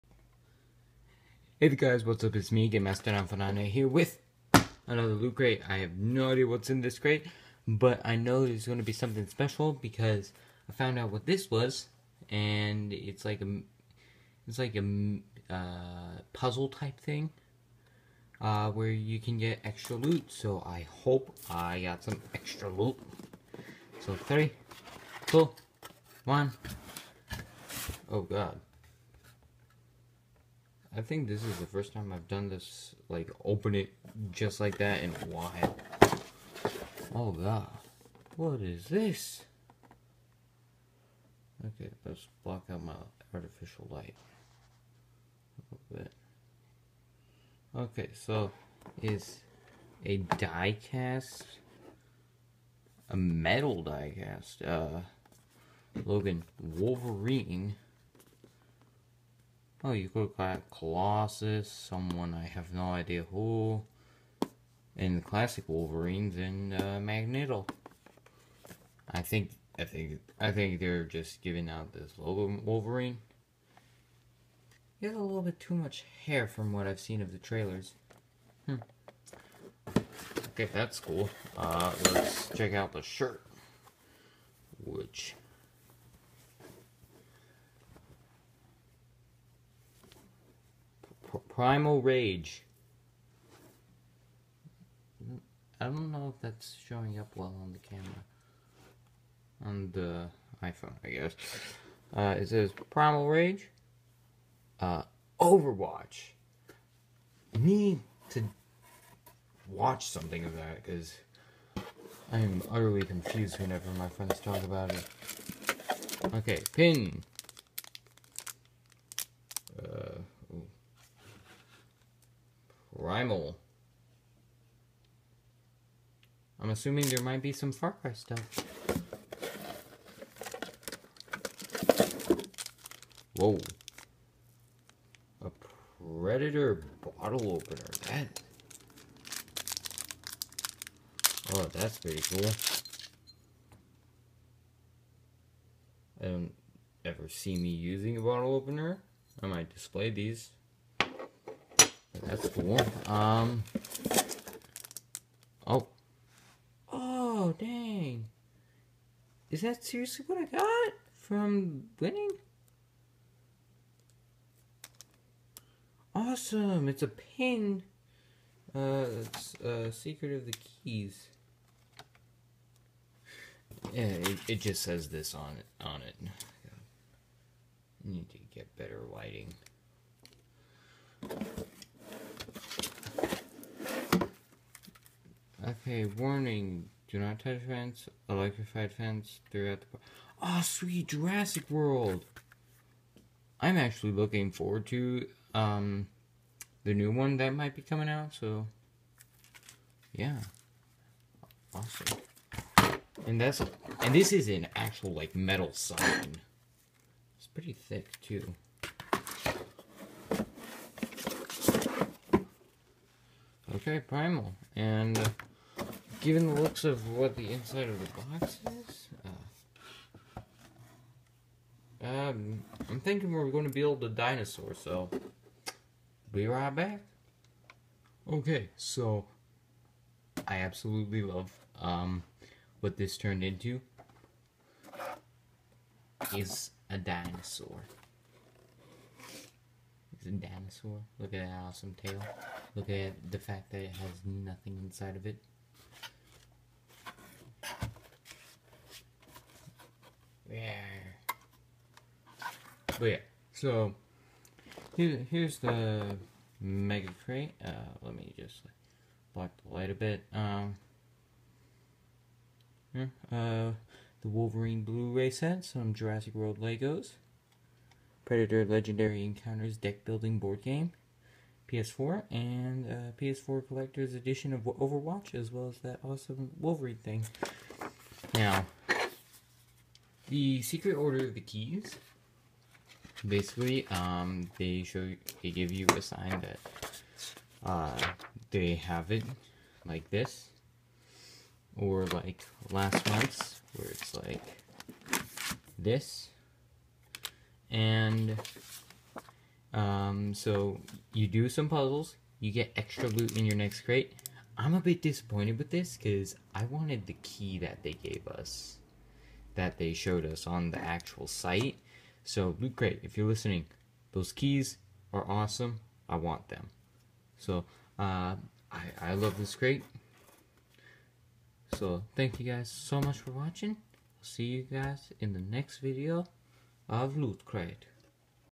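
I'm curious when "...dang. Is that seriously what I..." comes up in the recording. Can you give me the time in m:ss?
2:37.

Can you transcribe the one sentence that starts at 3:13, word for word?
I'm actually looking forward to um, the new one that might be coming out, so yeah.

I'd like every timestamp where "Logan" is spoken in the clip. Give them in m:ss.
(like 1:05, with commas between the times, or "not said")
0:56, 1:12.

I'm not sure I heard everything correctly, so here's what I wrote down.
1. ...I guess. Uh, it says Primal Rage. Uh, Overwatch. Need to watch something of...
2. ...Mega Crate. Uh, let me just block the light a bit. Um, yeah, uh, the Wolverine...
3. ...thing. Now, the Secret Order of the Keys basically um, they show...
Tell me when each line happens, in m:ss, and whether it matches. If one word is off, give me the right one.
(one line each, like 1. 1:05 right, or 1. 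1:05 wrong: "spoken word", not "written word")
1. 1:41 right
2. 4:16 right
3. 4:37 right.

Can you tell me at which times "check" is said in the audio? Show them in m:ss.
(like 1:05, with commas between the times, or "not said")
1:22.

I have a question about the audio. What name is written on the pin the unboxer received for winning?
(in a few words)
Secret of the Keys.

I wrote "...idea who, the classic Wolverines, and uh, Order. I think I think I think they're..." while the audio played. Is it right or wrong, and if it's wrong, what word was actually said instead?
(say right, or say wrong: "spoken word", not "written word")
wrong: "Magneto", not "Order".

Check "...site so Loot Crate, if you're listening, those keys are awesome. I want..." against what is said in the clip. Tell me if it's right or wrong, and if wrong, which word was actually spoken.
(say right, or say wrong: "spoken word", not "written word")
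right.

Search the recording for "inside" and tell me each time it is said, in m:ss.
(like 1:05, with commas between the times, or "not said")
3:37, 4:04.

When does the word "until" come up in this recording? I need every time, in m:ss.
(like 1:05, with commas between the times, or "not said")
not said.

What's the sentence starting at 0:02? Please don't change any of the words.
It's me, Game Master Fanane here with another loot crate.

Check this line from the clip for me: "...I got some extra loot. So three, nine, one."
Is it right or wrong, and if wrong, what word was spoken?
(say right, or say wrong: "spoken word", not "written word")
wrong: "two", not "nine".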